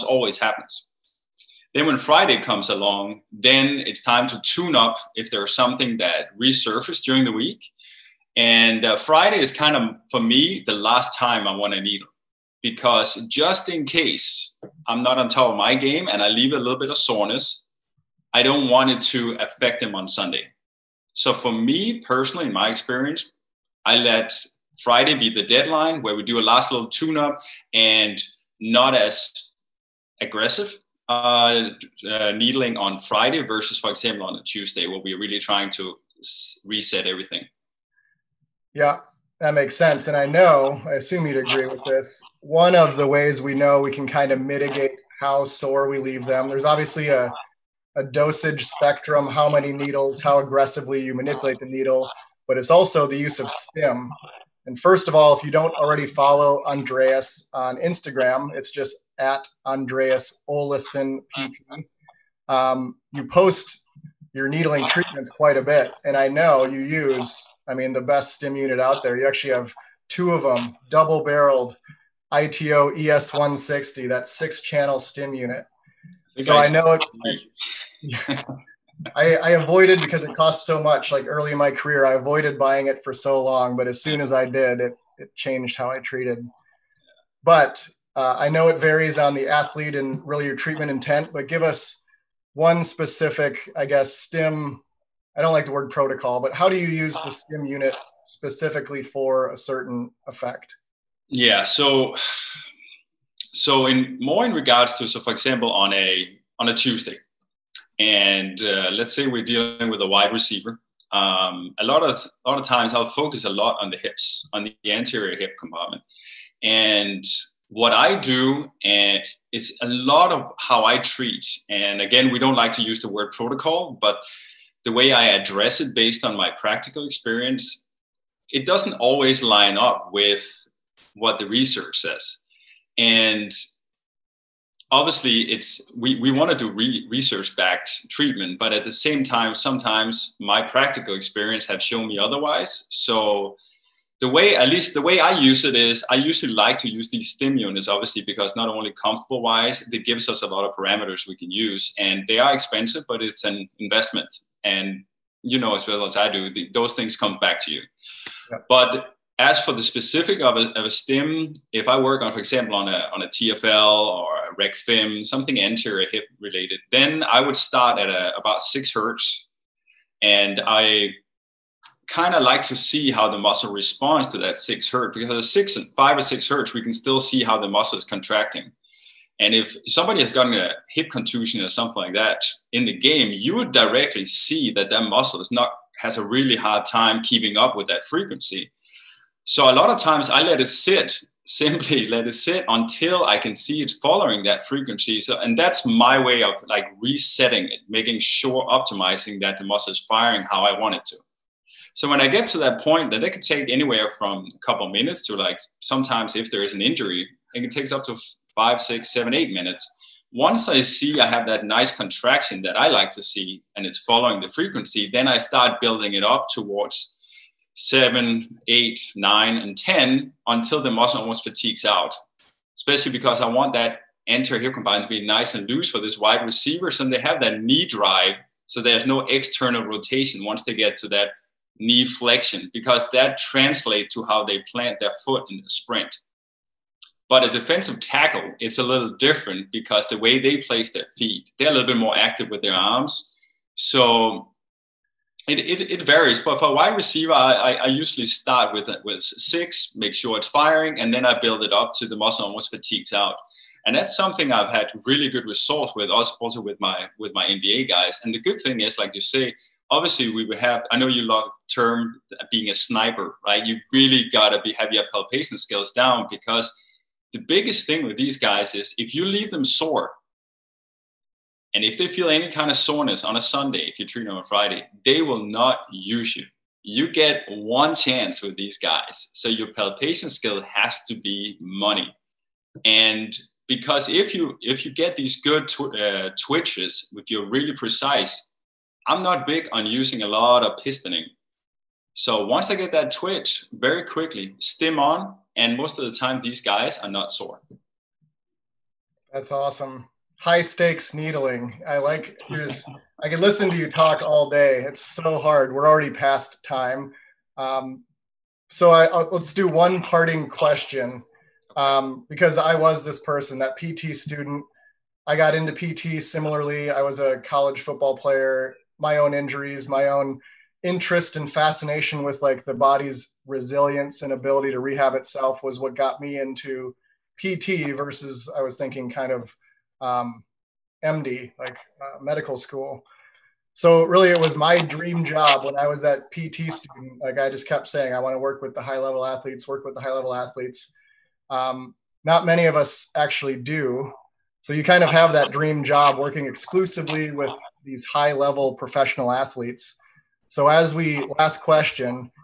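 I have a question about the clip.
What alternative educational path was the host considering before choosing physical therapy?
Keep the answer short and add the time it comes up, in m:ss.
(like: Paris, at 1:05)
Medical school, at 5:32.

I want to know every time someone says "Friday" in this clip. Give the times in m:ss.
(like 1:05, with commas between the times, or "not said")
0:01, 0:08, 0:24, 0:32, 4:34.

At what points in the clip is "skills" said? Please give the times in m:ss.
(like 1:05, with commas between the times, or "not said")
4:25, 4:40.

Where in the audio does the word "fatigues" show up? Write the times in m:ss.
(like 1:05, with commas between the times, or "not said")
3:41, 4:12.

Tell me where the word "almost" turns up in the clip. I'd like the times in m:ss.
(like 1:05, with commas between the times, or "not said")
3:41, 4:12.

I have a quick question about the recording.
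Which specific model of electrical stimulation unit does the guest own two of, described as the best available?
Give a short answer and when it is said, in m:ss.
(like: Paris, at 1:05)
ITO ES160, at 1:12.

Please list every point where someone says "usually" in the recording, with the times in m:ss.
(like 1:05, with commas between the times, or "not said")
2:26, 4:07.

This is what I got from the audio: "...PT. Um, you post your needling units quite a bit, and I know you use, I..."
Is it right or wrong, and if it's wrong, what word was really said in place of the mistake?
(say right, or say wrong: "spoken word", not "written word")
wrong: "treatments", not "units".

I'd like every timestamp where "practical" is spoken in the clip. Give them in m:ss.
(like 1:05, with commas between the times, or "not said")
2:06, 2:20.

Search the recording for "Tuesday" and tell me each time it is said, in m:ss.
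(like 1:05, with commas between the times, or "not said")
0:34, 1:46.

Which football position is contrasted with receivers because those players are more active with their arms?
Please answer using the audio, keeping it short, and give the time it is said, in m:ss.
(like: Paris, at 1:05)
Defensive tackle, at 3:57.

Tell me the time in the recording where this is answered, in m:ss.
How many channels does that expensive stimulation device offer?
1:14.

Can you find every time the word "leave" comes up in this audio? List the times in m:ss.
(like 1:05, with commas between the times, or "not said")
0:16, 0:45, 4:29.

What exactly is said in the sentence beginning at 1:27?
But uh, I know it varies on the athlete and really your treatment intent.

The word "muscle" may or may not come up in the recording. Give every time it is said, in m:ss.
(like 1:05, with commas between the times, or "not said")
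2:53, 2:57, 3:05, 3:19, 3:40, 4:12.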